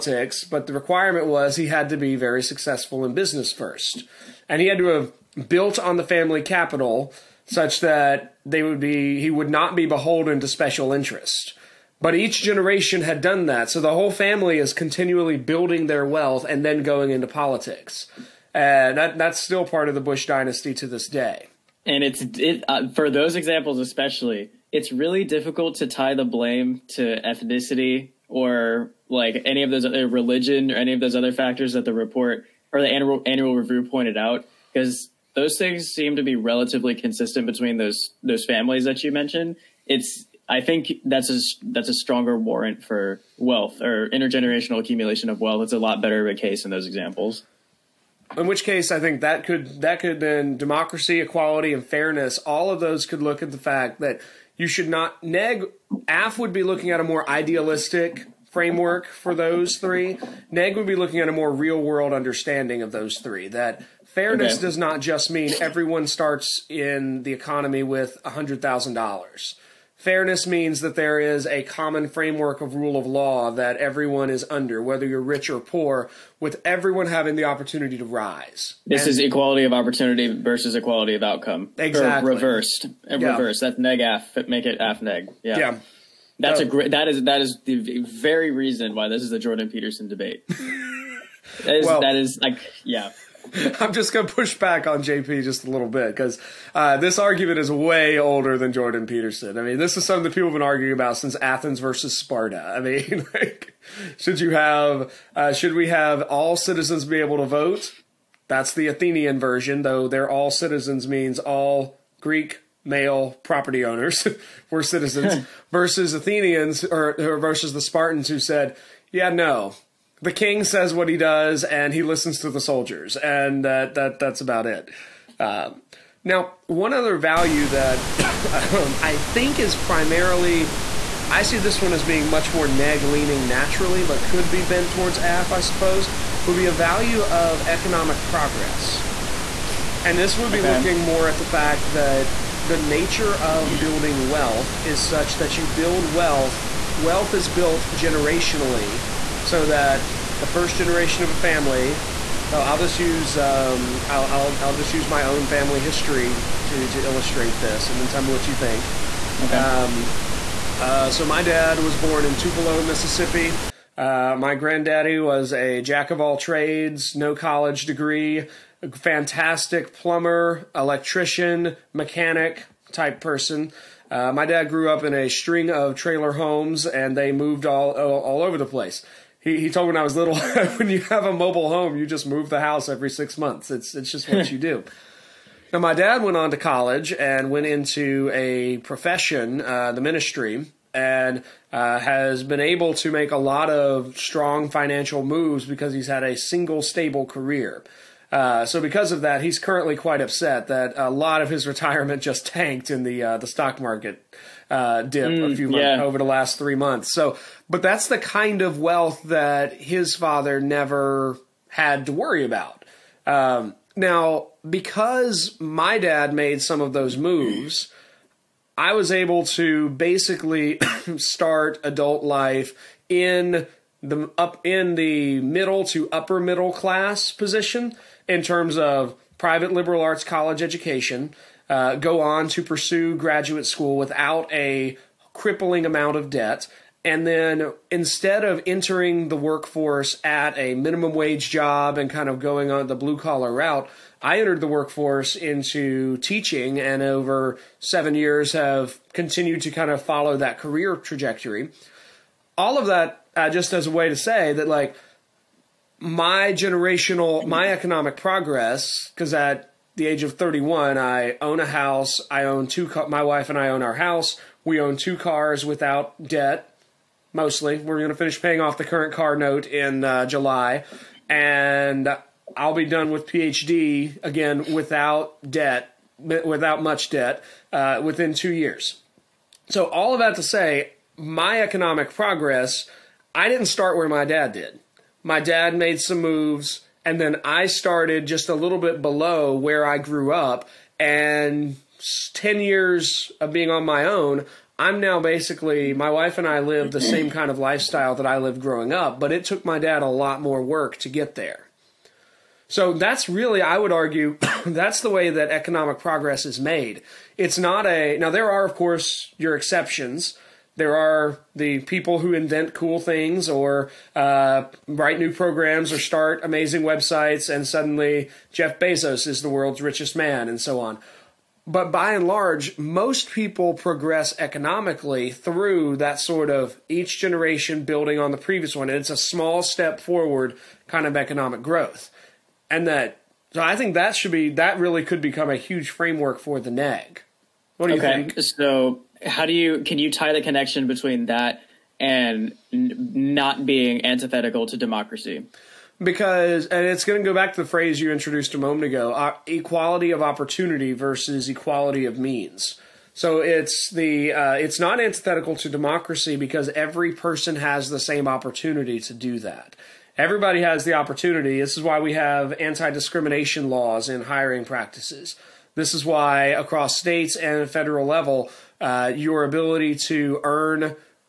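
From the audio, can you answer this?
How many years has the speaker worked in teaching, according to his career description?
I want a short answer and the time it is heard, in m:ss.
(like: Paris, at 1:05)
7, at 4:07.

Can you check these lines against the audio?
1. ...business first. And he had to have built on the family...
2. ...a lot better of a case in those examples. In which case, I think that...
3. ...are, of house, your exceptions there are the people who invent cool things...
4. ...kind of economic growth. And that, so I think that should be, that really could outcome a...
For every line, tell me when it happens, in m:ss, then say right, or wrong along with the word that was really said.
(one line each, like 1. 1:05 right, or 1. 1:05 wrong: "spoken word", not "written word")
1. 0:03 right
2. 0:45 right
3. 5:08 wrong: "course", not "house"
4. 5:30 wrong: "become", not "outcome".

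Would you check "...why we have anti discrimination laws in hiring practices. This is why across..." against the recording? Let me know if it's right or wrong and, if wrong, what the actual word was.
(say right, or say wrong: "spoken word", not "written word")
right.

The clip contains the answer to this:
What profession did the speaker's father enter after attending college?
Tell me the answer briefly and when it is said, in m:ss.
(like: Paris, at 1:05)
the ministry, at 3:09.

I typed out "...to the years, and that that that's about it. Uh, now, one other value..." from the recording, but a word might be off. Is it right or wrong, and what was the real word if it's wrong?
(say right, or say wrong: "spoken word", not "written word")
wrong: "soldiers", not "years".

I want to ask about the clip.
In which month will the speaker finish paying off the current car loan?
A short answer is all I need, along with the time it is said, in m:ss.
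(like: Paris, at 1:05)
July, at 4:30.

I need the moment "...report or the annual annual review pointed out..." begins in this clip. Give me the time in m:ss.
0:31.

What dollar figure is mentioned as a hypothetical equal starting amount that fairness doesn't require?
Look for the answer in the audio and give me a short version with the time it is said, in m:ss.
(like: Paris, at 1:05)
$100,000, at 1:08.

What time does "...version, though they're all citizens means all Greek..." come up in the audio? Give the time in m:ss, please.
1:49.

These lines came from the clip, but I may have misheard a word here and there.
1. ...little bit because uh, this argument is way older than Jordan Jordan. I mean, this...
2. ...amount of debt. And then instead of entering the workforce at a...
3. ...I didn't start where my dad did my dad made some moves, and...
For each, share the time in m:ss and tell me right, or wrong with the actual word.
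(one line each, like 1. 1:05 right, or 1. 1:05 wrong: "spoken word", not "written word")
1. 1:35 wrong: "Peterson", not "Jordan"
2. 3:55 right
3. 4:43 right.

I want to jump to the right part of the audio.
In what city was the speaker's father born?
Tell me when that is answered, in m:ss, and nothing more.
2:42.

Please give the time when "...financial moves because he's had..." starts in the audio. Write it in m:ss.
3:14.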